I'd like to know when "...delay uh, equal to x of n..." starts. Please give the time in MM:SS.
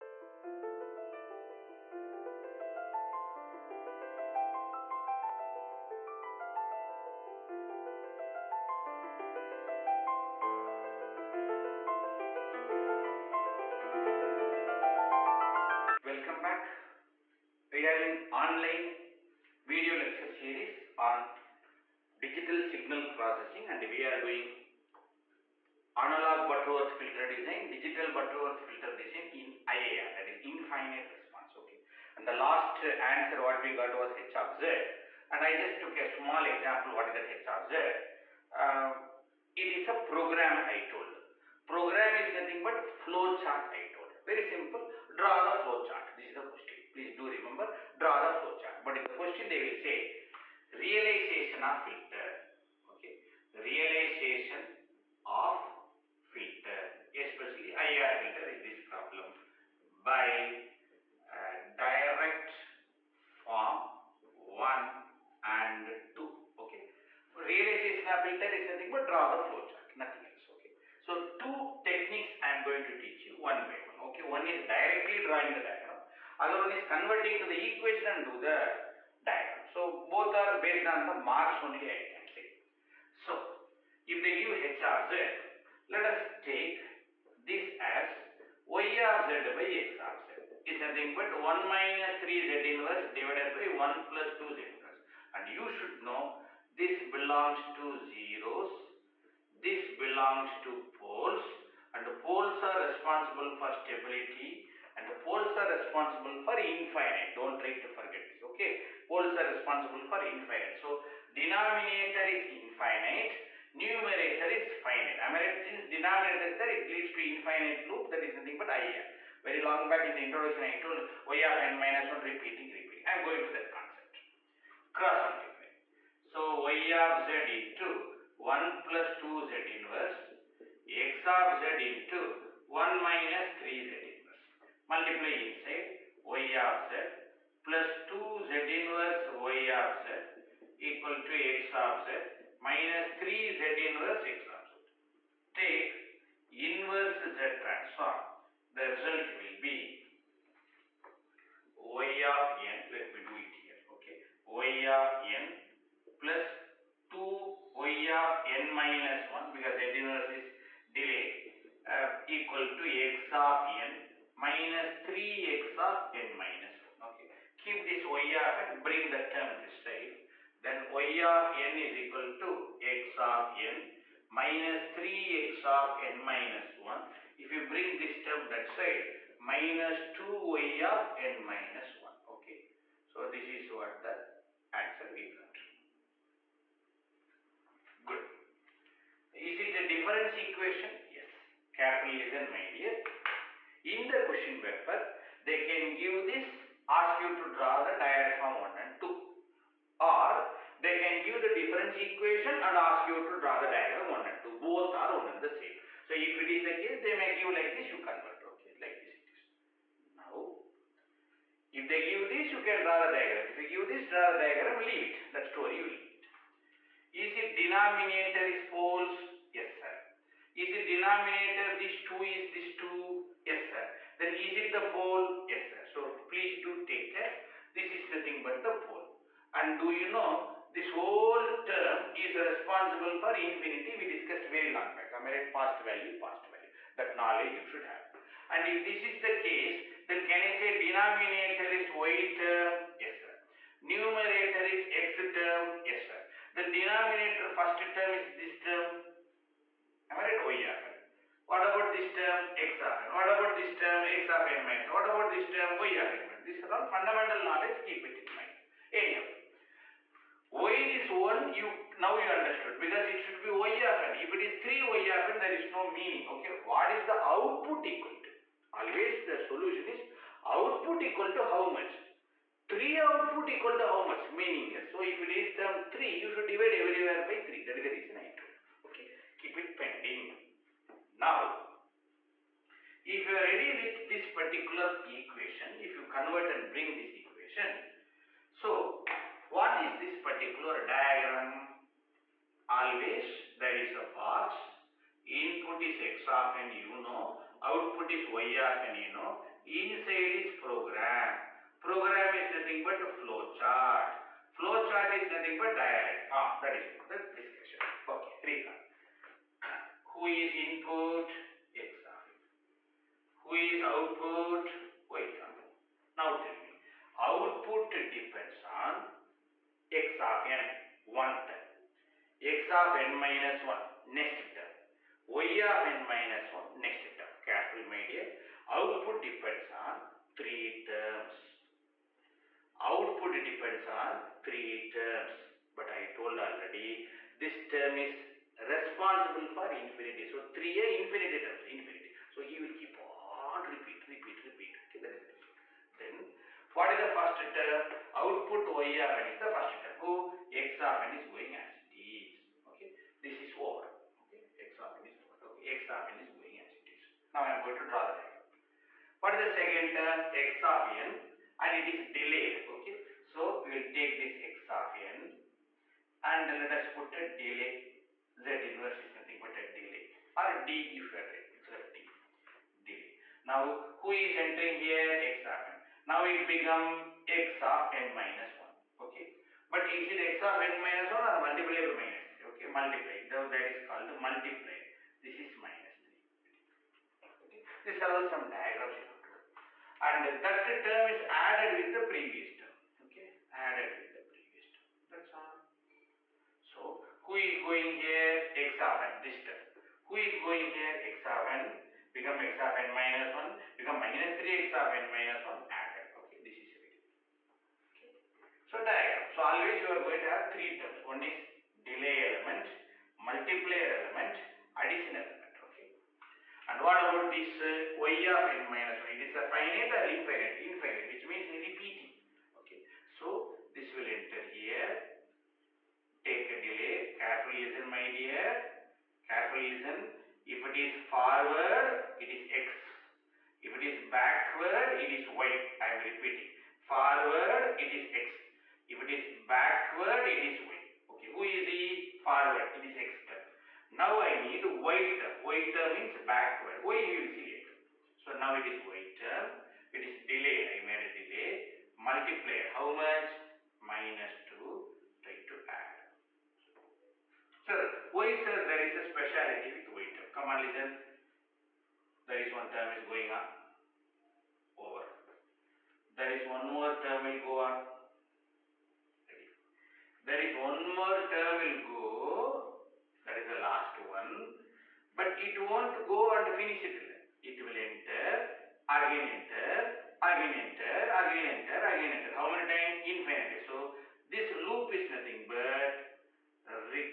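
02:40.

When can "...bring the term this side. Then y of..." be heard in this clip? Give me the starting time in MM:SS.
02:48.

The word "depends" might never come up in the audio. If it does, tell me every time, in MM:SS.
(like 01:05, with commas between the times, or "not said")
05:17, 05:29, 05:33.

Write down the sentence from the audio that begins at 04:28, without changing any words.
Always the solution is output equal to how much?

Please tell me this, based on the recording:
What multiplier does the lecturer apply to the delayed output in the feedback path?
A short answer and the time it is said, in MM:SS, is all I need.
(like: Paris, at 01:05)
minus 2, at 07:33.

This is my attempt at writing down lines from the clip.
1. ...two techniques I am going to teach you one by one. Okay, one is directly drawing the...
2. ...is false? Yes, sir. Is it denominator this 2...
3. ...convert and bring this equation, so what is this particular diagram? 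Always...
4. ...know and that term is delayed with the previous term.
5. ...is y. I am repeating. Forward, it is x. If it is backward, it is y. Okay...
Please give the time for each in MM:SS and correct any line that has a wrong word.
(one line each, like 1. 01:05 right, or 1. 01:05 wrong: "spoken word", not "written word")
1. 01:11 right
2. 03:38 right
3. 04:46 right
4. 06:29 wrong: "added", not "delayed"
5. 07:15 right.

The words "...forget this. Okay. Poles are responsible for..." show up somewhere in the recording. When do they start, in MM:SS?
01:47.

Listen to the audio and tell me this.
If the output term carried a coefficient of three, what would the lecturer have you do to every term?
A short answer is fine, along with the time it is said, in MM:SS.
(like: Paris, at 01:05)
divide by 3, at 04:36.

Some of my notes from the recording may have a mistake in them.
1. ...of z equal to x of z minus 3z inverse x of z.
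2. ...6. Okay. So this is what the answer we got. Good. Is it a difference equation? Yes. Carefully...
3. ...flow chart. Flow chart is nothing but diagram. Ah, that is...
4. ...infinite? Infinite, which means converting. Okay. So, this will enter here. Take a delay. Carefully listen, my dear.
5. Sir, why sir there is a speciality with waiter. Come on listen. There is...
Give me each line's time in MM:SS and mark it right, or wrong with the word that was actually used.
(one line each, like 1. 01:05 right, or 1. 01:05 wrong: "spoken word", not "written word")
1. 02:19 right
2. 03:02 wrong: "1", not "6"
3. 05:03 right
4. 07:00 wrong: "repeating", not "converting"
5. 07:37 right.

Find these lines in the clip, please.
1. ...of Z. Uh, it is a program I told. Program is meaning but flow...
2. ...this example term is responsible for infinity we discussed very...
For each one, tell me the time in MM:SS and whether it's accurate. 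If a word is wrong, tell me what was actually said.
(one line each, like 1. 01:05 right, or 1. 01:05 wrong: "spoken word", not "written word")
1. 00:37 wrong: "nothing", not "meaning"
2. 03:50 wrong: "whole", not "example".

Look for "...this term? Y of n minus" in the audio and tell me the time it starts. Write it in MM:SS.
04:15.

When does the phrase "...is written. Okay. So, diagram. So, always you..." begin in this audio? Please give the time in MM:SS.
06:46.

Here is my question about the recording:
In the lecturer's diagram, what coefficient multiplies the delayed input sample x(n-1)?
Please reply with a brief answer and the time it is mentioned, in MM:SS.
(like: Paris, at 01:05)
minus 3, at 06:25.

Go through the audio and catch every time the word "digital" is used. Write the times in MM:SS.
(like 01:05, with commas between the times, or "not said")
00:22, 00:27.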